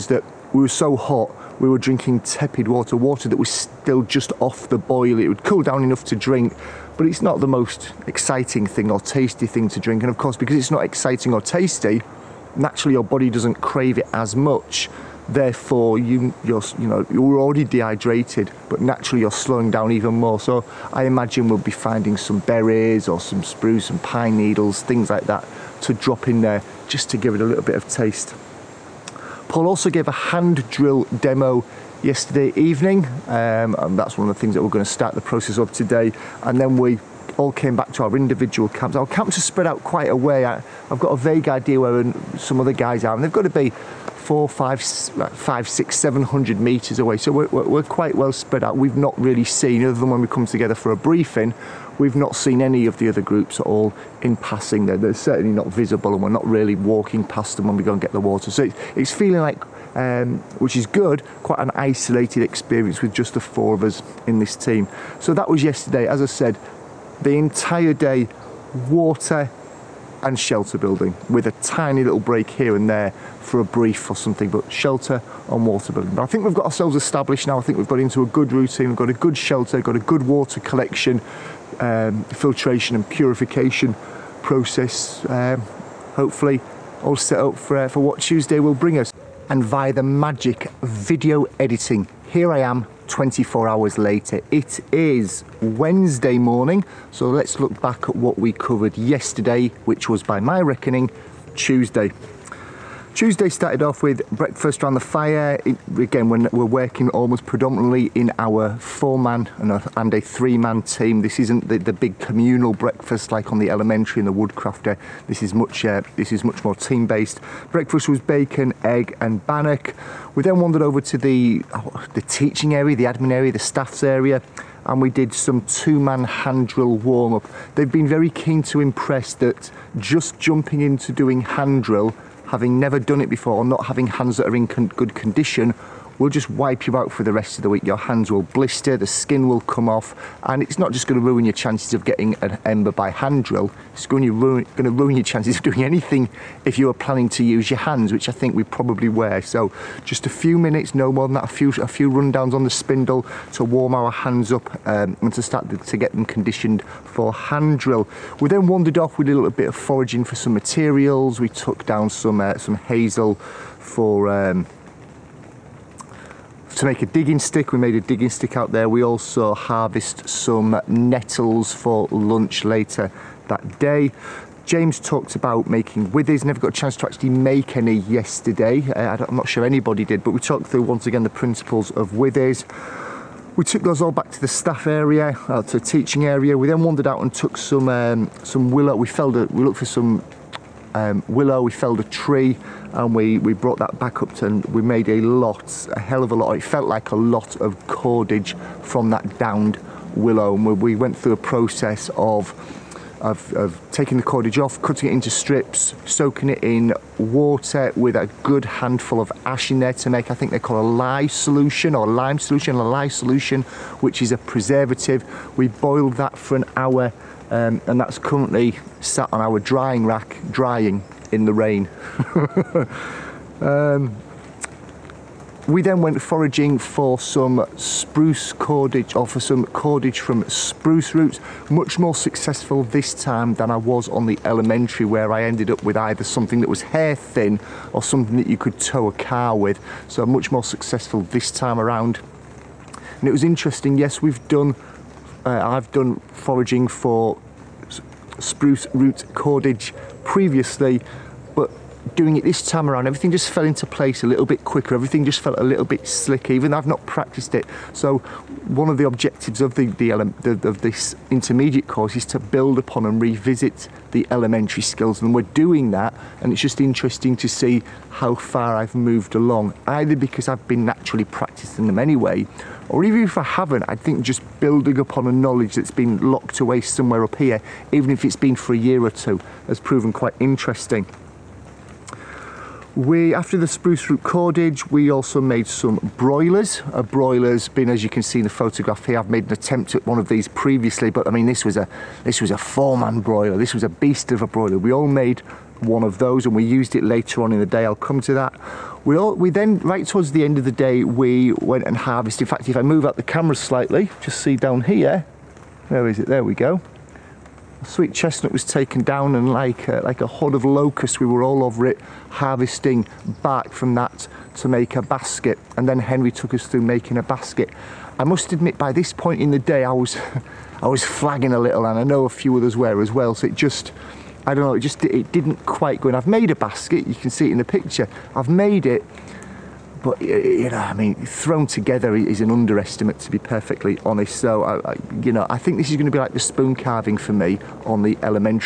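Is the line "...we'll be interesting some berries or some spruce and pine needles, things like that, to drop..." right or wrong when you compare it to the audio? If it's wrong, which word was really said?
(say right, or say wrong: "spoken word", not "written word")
wrong: "finding", not "interesting".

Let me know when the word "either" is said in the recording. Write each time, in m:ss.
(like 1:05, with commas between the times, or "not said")
3:55, 4:29.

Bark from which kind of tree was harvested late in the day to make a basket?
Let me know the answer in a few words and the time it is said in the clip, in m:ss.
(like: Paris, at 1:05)
sweet chestnut, at 5:07.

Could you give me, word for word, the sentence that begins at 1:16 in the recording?
But I think we've got ourselves established now.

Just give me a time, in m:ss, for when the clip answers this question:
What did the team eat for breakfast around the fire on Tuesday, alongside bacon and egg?
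1:59.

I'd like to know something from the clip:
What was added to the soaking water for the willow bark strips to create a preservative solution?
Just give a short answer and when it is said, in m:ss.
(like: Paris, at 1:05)
ash, at 3:29.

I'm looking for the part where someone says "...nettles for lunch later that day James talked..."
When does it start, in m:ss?
2:50.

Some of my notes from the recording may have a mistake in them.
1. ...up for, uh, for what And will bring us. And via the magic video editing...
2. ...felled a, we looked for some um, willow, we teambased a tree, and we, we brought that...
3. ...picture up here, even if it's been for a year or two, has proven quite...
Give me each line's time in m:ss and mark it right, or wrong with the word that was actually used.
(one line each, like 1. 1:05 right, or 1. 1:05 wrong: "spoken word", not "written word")
1. 1:27 wrong: "Tuesday", not "And"
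2. 3:09 wrong: "felled", not "teambased"
3. 4:36 wrong: "somewhere", not "picture".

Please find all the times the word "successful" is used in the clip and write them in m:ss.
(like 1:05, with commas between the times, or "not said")
3:52, 4:00.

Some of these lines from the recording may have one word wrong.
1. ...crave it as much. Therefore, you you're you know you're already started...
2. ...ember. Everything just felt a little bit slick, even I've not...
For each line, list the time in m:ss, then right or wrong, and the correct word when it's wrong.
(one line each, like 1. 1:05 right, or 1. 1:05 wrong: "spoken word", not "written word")
1. 0:13 wrong: "dehydrated", not "started"
2. 4:14 wrong: "quicker", not "ember".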